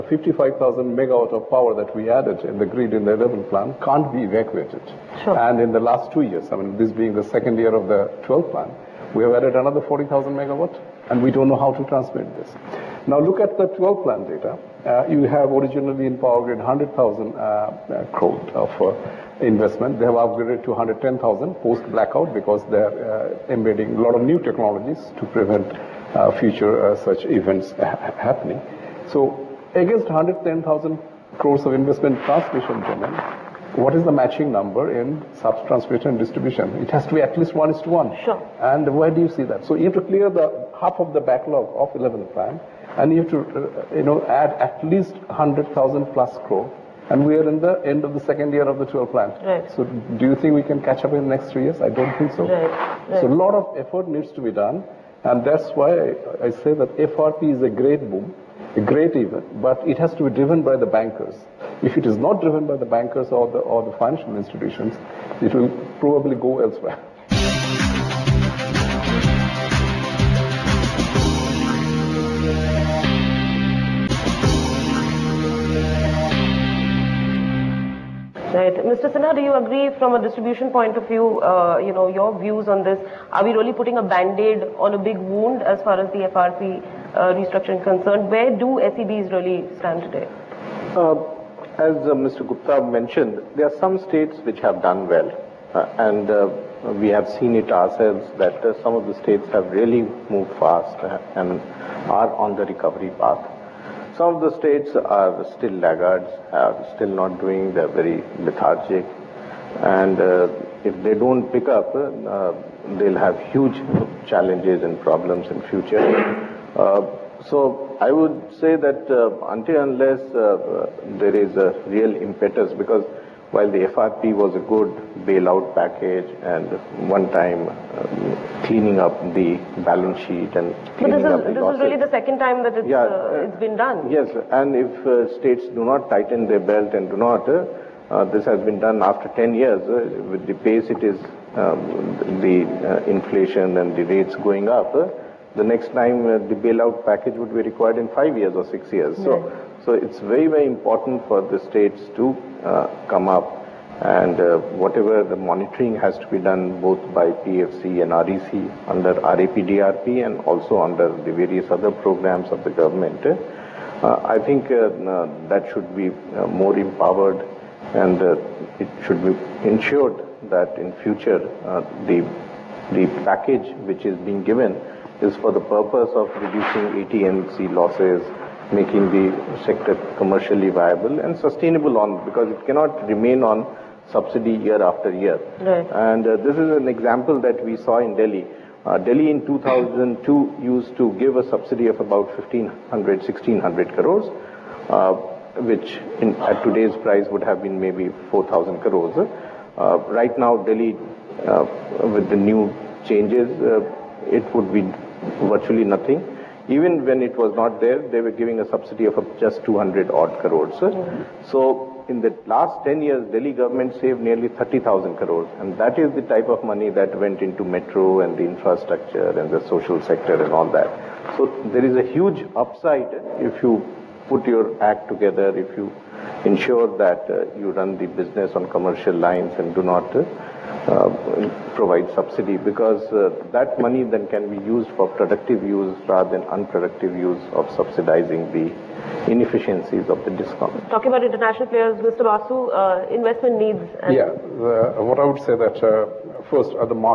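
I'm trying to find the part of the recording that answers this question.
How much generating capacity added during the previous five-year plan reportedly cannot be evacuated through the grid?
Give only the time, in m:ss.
0:00.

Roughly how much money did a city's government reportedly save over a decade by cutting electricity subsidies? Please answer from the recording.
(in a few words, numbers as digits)
30,000 crores.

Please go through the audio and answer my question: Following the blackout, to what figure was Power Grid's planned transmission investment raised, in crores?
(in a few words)
110,000 crores.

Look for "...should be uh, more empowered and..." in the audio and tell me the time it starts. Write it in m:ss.
2:45.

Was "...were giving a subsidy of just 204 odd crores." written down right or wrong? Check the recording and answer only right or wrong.
wrong.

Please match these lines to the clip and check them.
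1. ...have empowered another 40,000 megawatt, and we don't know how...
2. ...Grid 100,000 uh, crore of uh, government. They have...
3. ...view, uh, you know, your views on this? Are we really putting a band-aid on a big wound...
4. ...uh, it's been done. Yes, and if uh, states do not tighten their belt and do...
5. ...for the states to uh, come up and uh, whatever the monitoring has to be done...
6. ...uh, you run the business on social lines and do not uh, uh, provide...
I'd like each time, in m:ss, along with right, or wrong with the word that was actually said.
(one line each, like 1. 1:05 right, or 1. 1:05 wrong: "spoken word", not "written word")
1. 0:09 wrong: "added", not "empowered"
2. 0:16 wrong: "investment", not "government"
3. 1:21 right
4. 2:13 right
5. 2:31 right
6. 3:47 wrong: "commercial", not "social".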